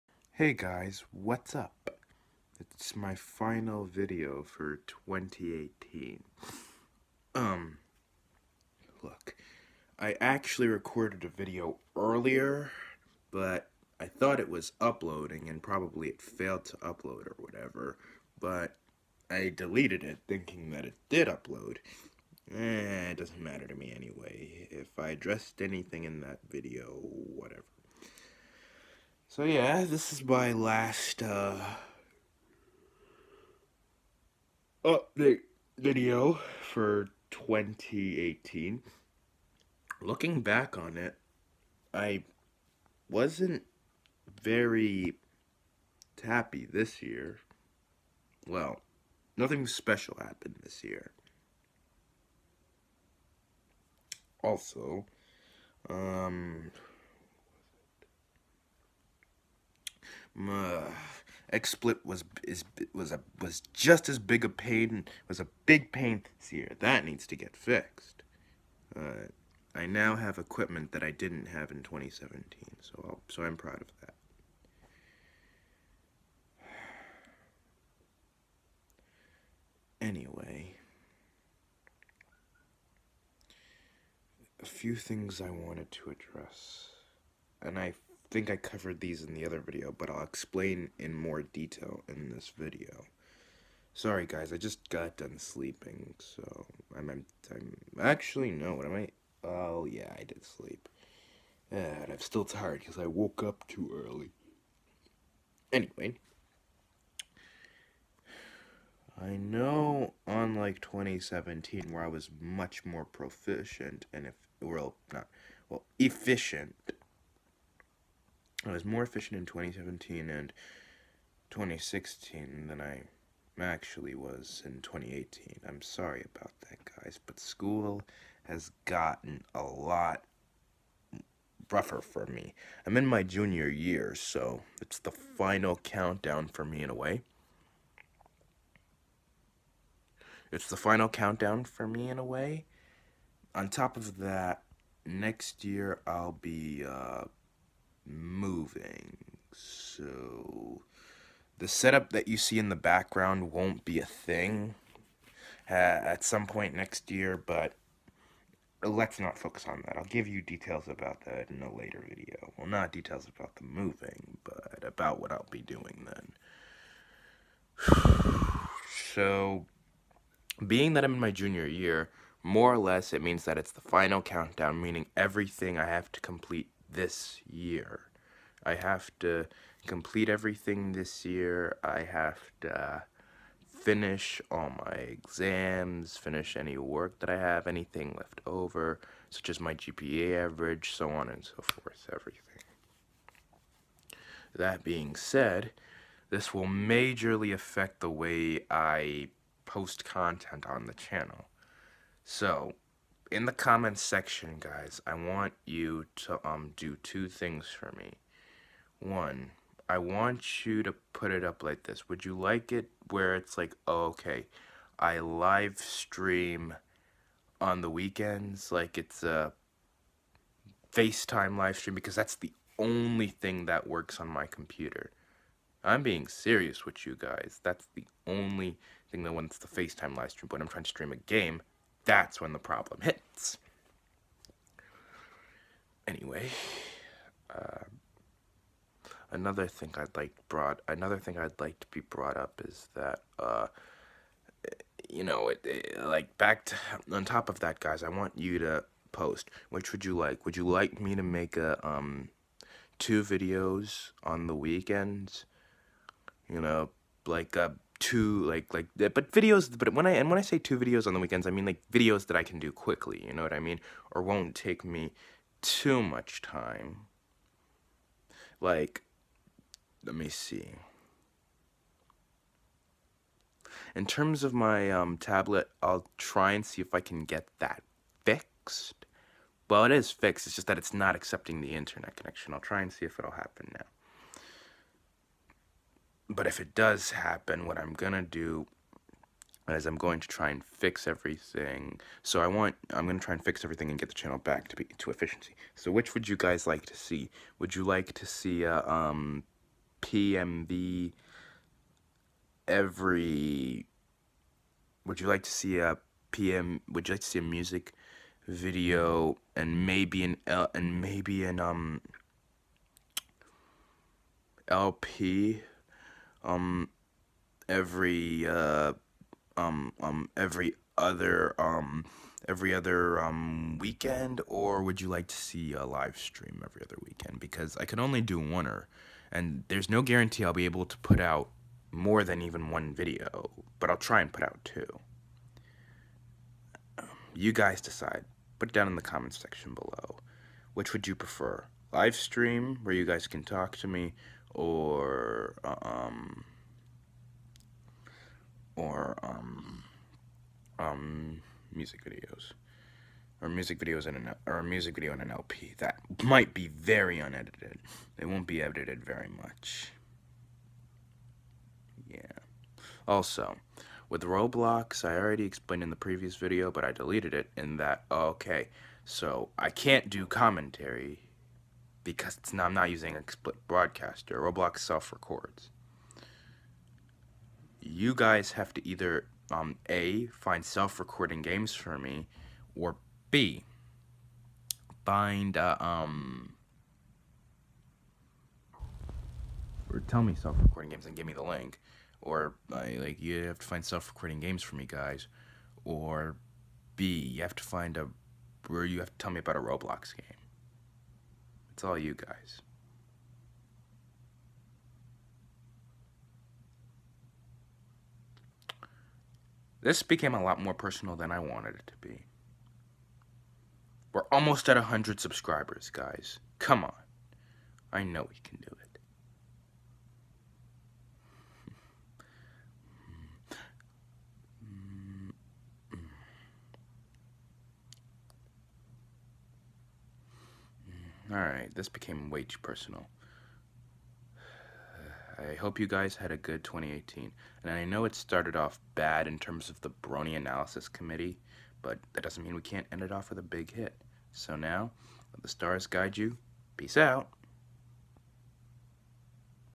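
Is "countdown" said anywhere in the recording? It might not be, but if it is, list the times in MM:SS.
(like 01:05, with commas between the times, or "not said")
02:15, 02:21, 02:54.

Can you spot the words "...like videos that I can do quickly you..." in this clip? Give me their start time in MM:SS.
04:21.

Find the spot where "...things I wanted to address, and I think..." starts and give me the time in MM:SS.
01:24.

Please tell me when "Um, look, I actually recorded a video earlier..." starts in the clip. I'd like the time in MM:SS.
00:07.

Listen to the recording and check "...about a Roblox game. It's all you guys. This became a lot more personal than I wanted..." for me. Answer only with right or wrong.
right.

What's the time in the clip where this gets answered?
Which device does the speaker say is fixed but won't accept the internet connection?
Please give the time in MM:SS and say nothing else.
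04:35.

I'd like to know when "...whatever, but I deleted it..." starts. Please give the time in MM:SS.
00:17.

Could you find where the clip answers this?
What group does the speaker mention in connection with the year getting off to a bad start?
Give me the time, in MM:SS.
07:19.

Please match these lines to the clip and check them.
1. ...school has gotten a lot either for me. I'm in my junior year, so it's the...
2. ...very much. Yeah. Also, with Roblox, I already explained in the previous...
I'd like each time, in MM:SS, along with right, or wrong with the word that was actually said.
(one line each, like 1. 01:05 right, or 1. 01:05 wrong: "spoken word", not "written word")
1. 02:07 wrong: "rougher", not "either"
2. 05:59 right.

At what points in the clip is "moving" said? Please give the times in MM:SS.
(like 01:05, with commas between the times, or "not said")
02:28, 02:43.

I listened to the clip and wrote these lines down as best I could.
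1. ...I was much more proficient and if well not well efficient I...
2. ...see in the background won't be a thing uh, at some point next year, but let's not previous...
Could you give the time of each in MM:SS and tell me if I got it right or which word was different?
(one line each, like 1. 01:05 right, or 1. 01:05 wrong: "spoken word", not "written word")
1. 01:52 right
2. 02:32 wrong: "focus", not "previous".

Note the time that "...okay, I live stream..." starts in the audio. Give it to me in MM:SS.
03:34.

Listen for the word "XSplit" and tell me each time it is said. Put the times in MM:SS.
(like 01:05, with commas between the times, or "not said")
01:01, 06:13.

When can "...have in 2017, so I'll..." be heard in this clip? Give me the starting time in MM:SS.
01:11.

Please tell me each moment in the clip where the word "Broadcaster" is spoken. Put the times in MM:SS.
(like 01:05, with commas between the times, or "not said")
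06:13.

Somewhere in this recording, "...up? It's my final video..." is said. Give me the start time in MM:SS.
00:01.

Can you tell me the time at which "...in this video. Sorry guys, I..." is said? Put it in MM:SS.
01:32.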